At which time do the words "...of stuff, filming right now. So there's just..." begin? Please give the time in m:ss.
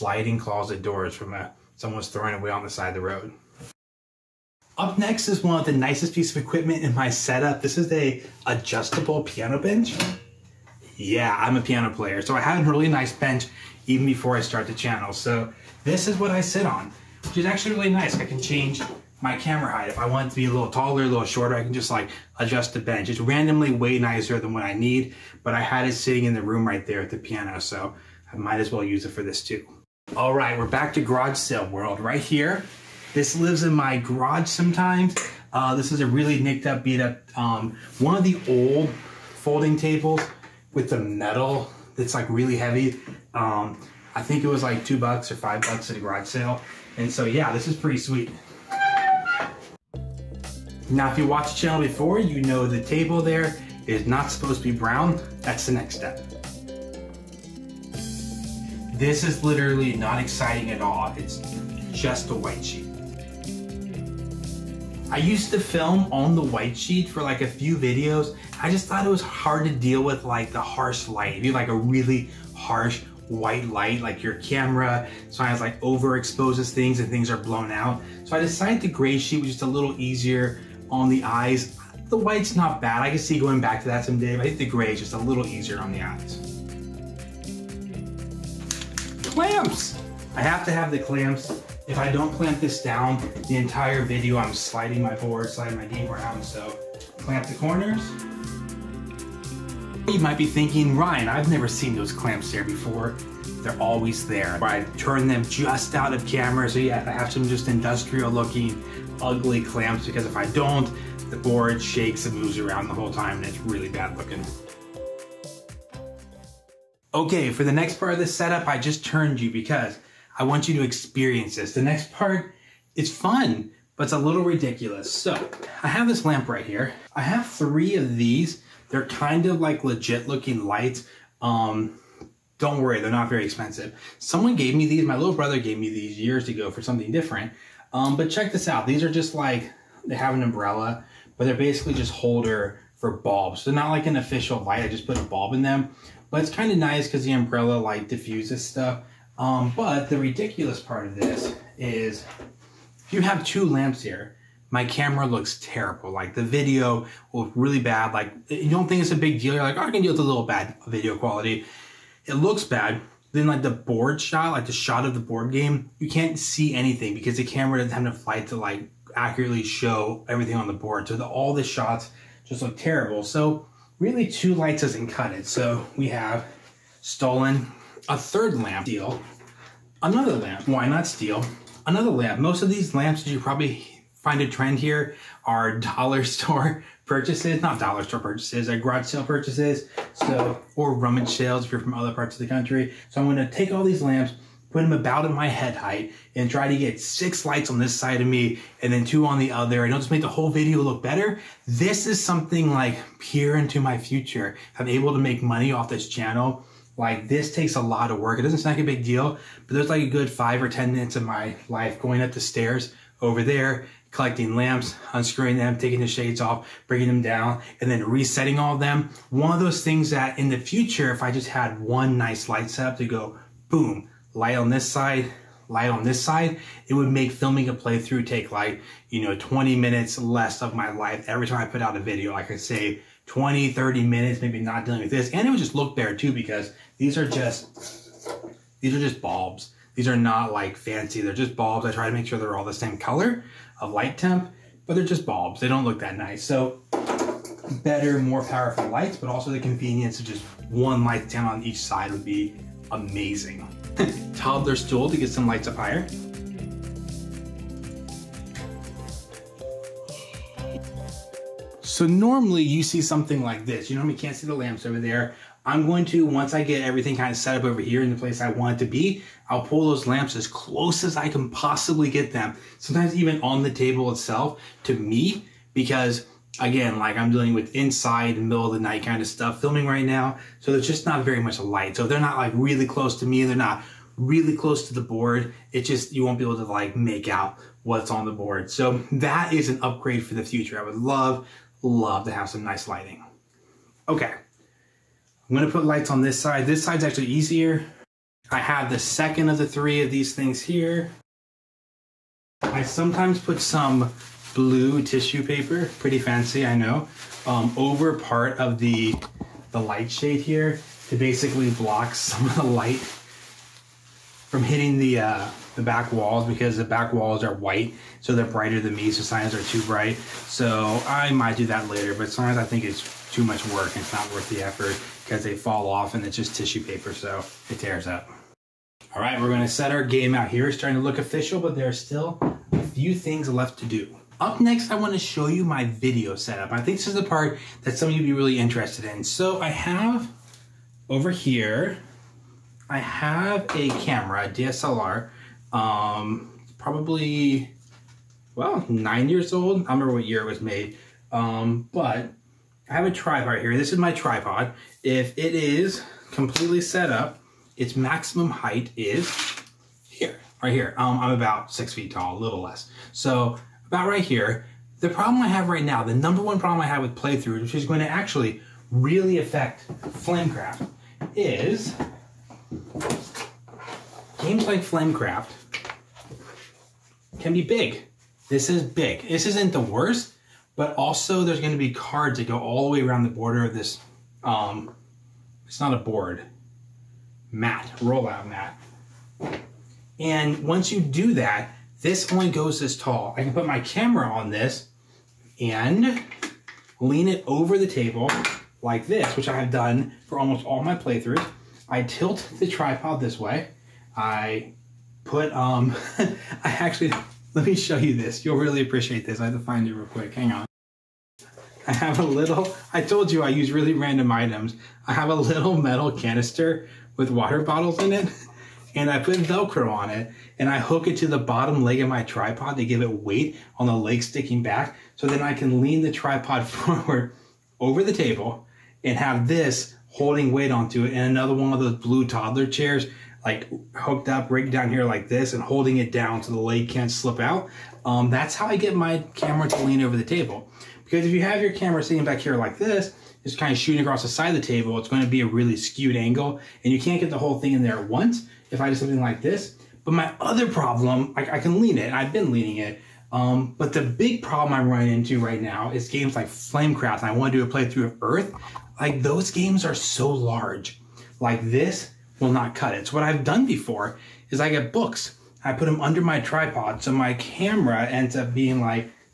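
4:39.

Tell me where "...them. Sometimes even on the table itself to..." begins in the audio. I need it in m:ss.
4:32.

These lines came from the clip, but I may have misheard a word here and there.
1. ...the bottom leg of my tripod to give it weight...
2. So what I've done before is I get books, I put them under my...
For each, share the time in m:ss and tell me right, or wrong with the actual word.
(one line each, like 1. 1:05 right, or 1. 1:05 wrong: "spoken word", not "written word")
1. 7:01 right
2. 7:43 right.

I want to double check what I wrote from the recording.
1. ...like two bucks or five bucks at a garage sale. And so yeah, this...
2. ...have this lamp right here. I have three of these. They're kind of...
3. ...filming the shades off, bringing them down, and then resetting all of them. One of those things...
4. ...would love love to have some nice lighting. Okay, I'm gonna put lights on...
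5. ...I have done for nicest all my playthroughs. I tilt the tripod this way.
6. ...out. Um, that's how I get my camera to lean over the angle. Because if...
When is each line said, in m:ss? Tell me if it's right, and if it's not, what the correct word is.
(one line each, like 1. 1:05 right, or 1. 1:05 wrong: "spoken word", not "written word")
1. 0:44 right
2. 2:05 right
3. 3:35 wrong: "taking", not "filming"
4. 4:50 right
5. 6:39 wrong: "almost", not "nicest"
6. 7:17 wrong: "table", not "angle".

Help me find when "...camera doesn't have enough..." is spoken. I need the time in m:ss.
2:47.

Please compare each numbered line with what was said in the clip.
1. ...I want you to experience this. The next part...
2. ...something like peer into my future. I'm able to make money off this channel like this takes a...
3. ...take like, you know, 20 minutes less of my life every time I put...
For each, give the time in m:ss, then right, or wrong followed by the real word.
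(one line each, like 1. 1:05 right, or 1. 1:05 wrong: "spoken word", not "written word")
1. 2:00 right
2. 3:22 right
3. 3:48 right.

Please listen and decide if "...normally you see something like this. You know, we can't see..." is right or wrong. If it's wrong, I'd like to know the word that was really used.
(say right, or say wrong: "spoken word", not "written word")
right.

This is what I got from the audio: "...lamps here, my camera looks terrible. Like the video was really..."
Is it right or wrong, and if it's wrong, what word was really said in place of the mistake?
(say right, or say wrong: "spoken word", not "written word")
right.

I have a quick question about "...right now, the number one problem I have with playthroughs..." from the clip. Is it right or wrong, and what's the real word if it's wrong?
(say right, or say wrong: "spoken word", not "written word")
right.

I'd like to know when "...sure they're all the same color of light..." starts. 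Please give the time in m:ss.
4:02.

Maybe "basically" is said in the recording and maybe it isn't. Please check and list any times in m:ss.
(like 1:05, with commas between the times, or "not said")
2:21, 5:11.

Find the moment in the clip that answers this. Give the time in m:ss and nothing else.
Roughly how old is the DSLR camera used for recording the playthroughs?
5:48.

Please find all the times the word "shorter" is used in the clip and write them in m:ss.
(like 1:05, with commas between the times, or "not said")
0:21.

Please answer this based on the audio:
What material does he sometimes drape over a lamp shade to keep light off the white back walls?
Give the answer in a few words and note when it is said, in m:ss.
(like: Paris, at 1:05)
Blue tissue paper, at 5:04.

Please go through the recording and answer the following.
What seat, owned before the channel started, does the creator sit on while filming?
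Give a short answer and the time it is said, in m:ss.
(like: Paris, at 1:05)
Adjustable piano bench, at 0:08.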